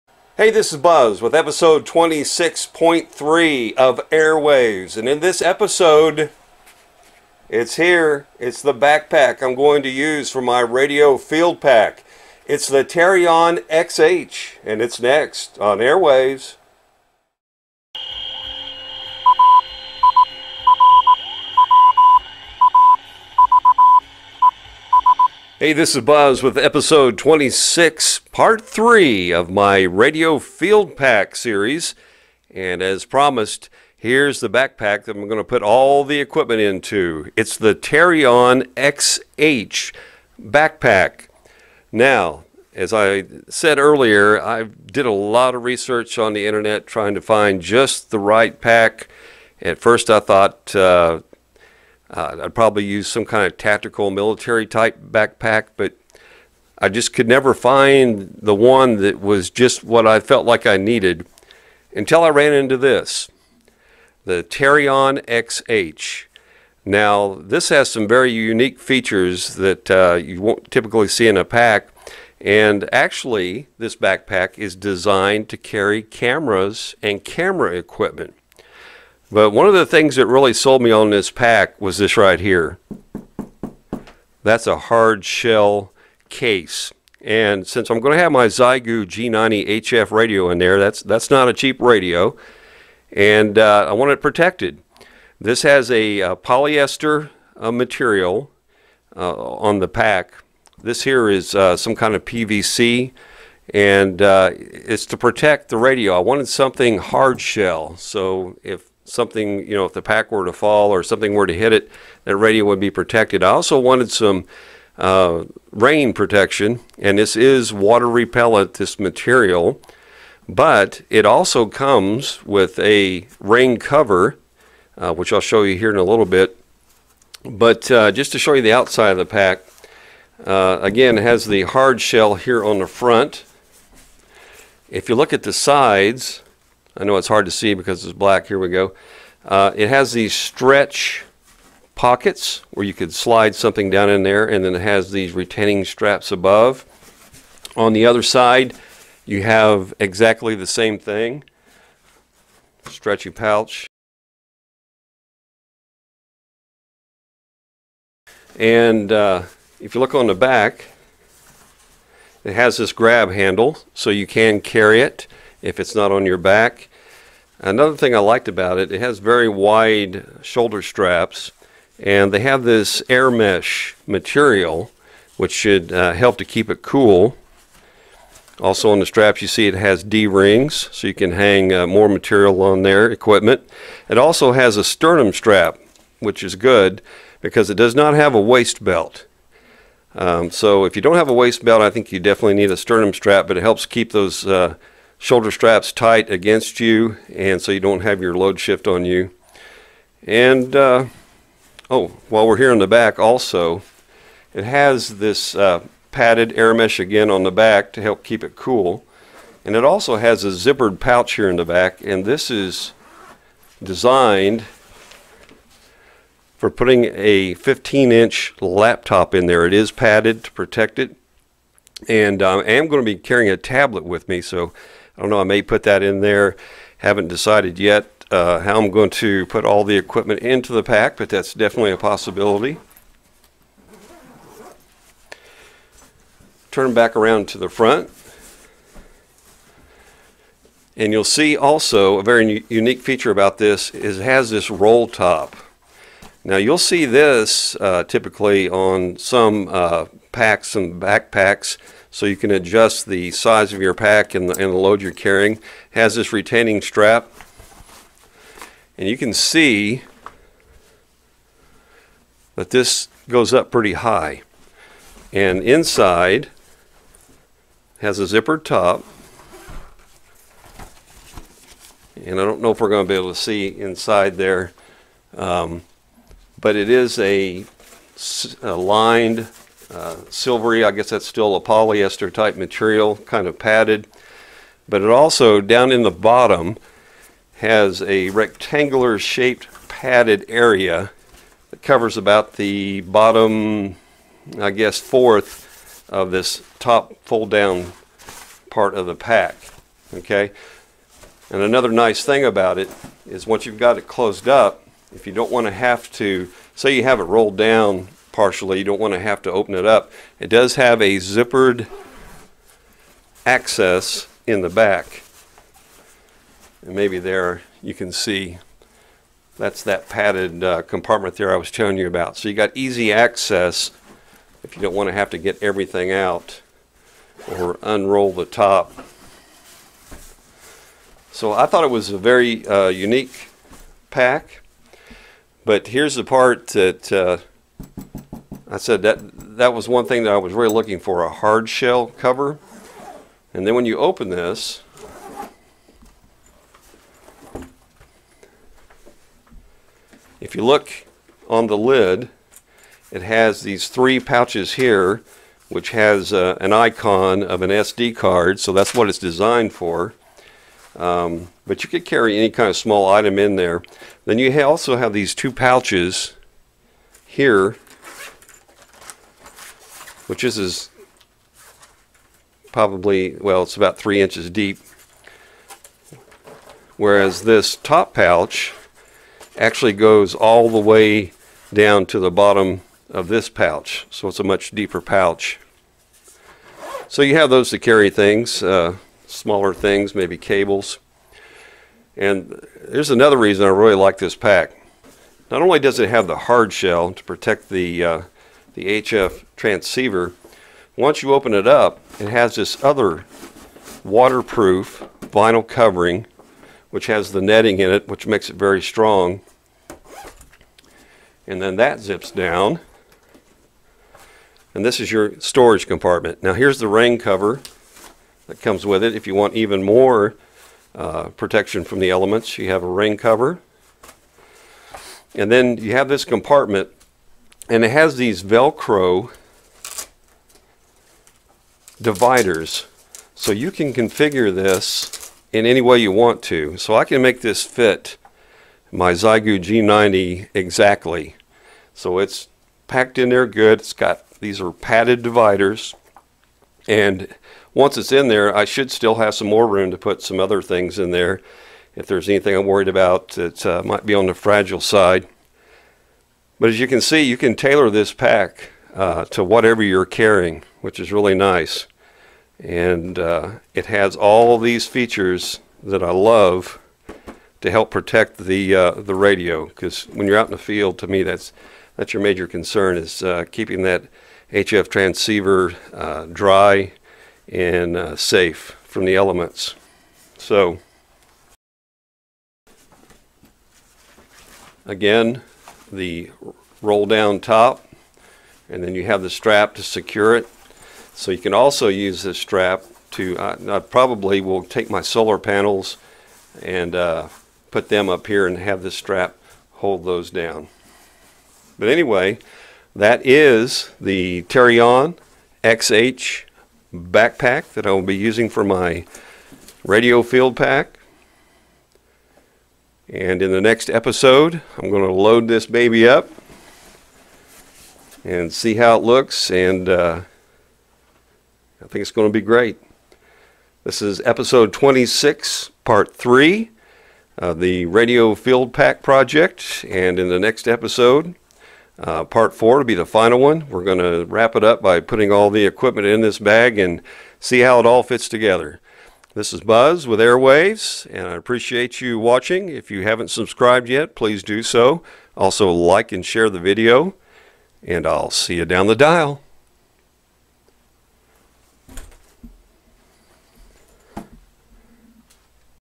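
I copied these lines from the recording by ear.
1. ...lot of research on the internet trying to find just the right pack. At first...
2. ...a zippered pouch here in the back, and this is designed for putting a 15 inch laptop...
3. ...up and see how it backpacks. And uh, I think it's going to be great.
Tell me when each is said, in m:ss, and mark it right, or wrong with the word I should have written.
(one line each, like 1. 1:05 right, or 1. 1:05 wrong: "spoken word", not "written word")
1. 0:45 right
2. 3:30 right
3. 8:36 wrong: "looks", not "backpacks".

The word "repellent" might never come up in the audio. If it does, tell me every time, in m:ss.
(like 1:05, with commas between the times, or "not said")
1:58.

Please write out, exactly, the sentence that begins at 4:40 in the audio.
I guess that's still a polyester type material, kind of padded.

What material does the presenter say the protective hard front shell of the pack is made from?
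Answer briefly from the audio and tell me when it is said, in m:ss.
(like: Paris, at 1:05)
PVC, at 1:42.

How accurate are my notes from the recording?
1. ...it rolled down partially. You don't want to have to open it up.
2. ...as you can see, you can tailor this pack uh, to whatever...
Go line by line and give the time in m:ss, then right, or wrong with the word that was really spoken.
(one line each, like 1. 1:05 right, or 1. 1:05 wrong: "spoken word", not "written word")
1. 5:07 right
2. 7:36 right.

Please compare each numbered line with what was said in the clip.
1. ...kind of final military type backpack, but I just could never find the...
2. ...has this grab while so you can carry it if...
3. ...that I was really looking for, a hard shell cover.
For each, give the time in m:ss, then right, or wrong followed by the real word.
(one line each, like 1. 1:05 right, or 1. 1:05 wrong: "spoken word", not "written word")
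1. 0:53 wrong: "tactical", not "final"
2. 2:42 wrong: "handle", not "while"
3. 5:40 right.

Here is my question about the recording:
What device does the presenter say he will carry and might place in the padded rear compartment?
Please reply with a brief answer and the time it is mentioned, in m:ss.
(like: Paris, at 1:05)
A tablet, at 3:43.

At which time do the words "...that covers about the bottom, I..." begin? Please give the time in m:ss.
4:51.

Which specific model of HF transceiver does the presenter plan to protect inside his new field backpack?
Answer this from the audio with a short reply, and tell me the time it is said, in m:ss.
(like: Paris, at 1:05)
Xiegu G90, at 1:28.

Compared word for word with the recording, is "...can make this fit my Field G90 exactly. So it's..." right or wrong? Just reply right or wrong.
wrong.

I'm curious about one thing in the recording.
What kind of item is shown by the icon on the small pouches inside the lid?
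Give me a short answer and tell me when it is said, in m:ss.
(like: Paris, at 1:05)
SD card, at 5:57.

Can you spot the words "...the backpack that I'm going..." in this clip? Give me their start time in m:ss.
0:34.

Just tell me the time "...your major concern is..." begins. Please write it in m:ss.
7:52.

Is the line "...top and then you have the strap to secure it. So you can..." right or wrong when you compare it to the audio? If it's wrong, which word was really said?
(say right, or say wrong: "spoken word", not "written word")
right.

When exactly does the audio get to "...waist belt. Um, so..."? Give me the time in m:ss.
3:08.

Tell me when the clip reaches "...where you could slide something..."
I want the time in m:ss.
2:22.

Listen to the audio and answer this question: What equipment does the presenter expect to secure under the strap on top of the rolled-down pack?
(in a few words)
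Solar panels.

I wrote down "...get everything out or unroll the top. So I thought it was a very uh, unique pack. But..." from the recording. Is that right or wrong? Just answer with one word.
right.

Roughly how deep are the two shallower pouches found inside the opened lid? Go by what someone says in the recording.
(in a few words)
3 inches.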